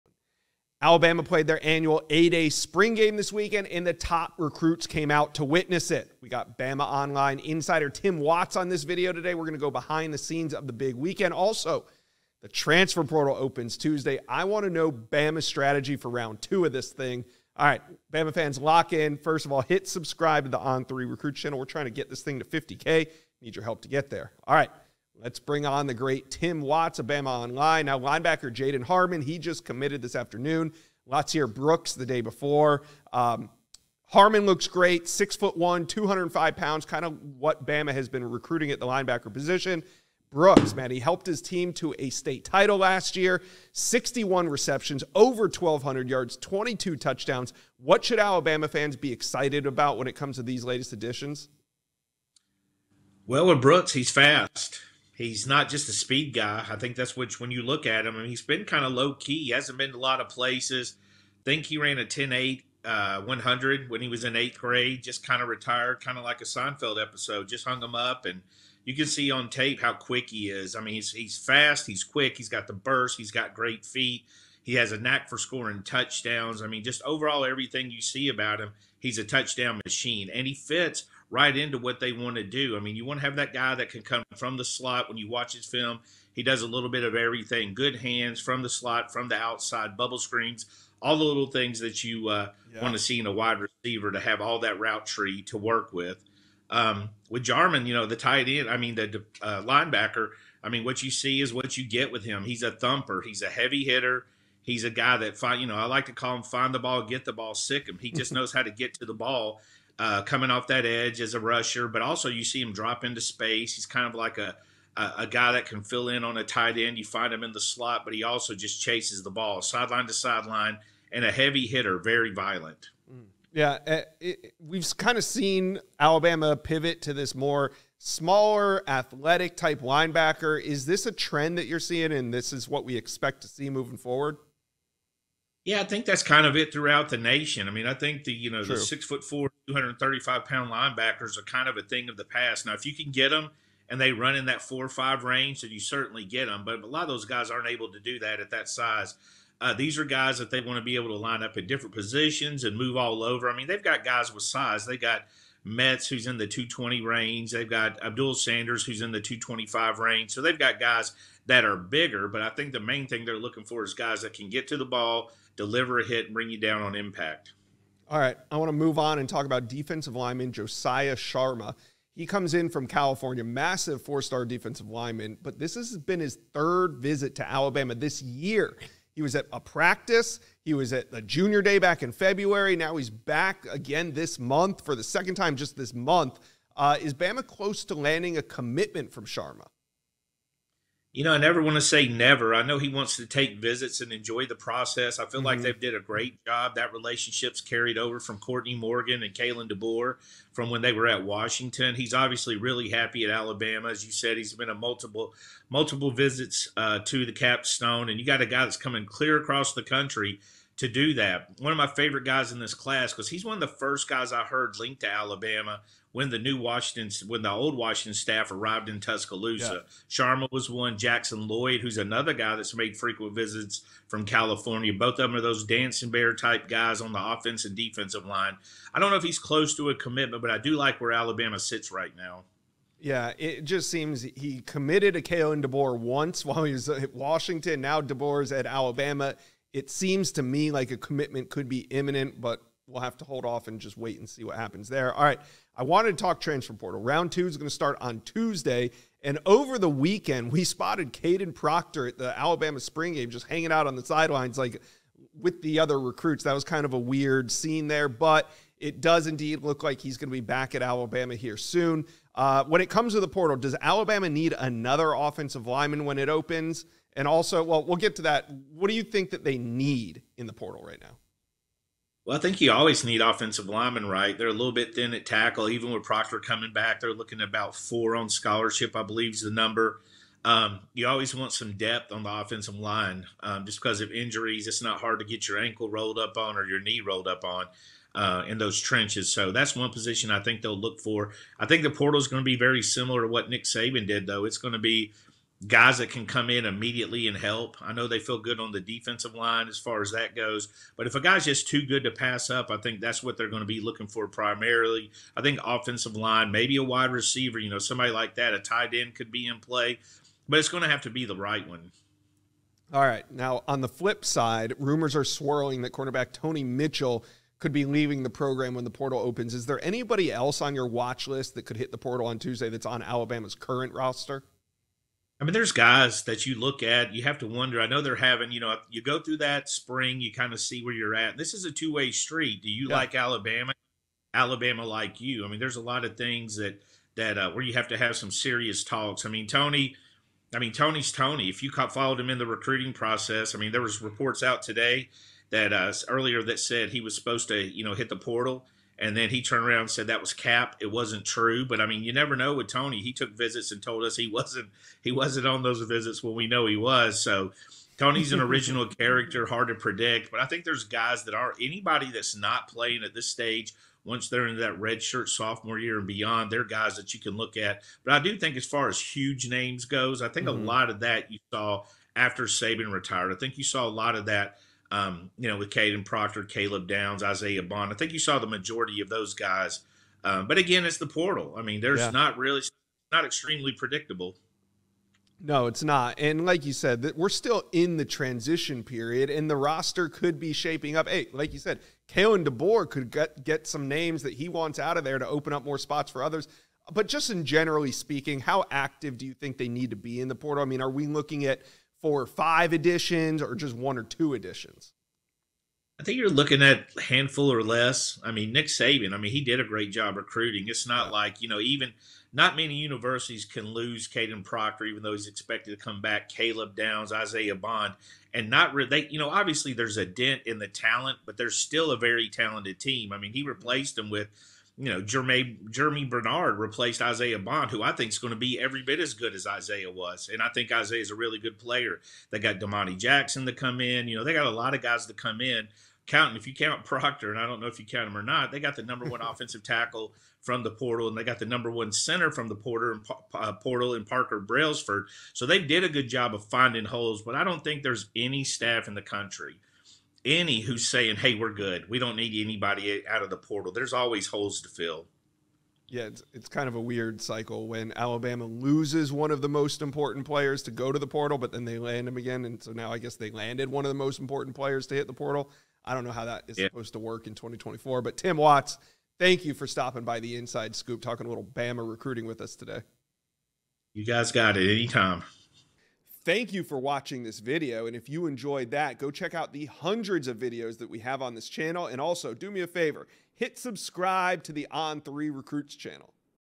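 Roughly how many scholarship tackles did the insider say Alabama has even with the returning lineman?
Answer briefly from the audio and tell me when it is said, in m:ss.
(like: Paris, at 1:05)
4, at 4:37.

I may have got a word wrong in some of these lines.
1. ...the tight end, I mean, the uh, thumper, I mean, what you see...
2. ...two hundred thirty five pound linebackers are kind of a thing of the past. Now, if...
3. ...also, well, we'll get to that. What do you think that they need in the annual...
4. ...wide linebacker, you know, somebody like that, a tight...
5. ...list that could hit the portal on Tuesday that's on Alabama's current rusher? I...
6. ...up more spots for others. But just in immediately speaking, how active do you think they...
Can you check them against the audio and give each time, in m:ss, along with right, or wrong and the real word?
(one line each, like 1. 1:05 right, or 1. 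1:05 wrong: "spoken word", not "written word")
1. 1:38 wrong: "linebacker", not "thumper"
2. 2:19 right
3. 4:27 wrong: "portal", not "annual"
4. 5:06 wrong: "receiver", not "linebacker"
5. 5:21 wrong: "roster", not "rusher"
6. 6:35 wrong: "generally", not "immediately".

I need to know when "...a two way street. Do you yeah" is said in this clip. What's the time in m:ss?
5:31.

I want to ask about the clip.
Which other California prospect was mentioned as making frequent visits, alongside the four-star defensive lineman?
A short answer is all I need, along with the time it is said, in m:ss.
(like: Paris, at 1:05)
Jackson Lloyd, at 3:40.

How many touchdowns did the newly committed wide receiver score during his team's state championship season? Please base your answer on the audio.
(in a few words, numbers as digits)
22.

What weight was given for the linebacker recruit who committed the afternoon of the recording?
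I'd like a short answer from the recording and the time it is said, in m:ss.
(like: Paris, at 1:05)
205 pounds, at 0:35.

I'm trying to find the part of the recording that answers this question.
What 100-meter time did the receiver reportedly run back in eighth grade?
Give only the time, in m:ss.
1:02.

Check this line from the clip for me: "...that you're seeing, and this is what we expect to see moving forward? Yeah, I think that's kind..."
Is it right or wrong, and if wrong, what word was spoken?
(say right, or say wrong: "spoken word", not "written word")
right.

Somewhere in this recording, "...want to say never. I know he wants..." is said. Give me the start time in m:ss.
3:11.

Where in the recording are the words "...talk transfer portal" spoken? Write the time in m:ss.
4:06.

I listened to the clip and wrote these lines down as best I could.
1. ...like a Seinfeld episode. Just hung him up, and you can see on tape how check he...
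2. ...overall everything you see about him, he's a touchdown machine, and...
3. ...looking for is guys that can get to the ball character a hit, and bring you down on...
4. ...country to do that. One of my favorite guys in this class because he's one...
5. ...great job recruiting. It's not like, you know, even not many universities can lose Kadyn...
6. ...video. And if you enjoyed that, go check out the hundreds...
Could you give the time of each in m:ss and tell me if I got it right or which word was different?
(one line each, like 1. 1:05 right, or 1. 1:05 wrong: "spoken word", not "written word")
1. 1:06 wrong: "quick", not "check"
2. 1:17 right
3. 2:43 wrong: "deliver", not "character"
4. 3:29 right
5. 6:49 right
6. 7:57 right.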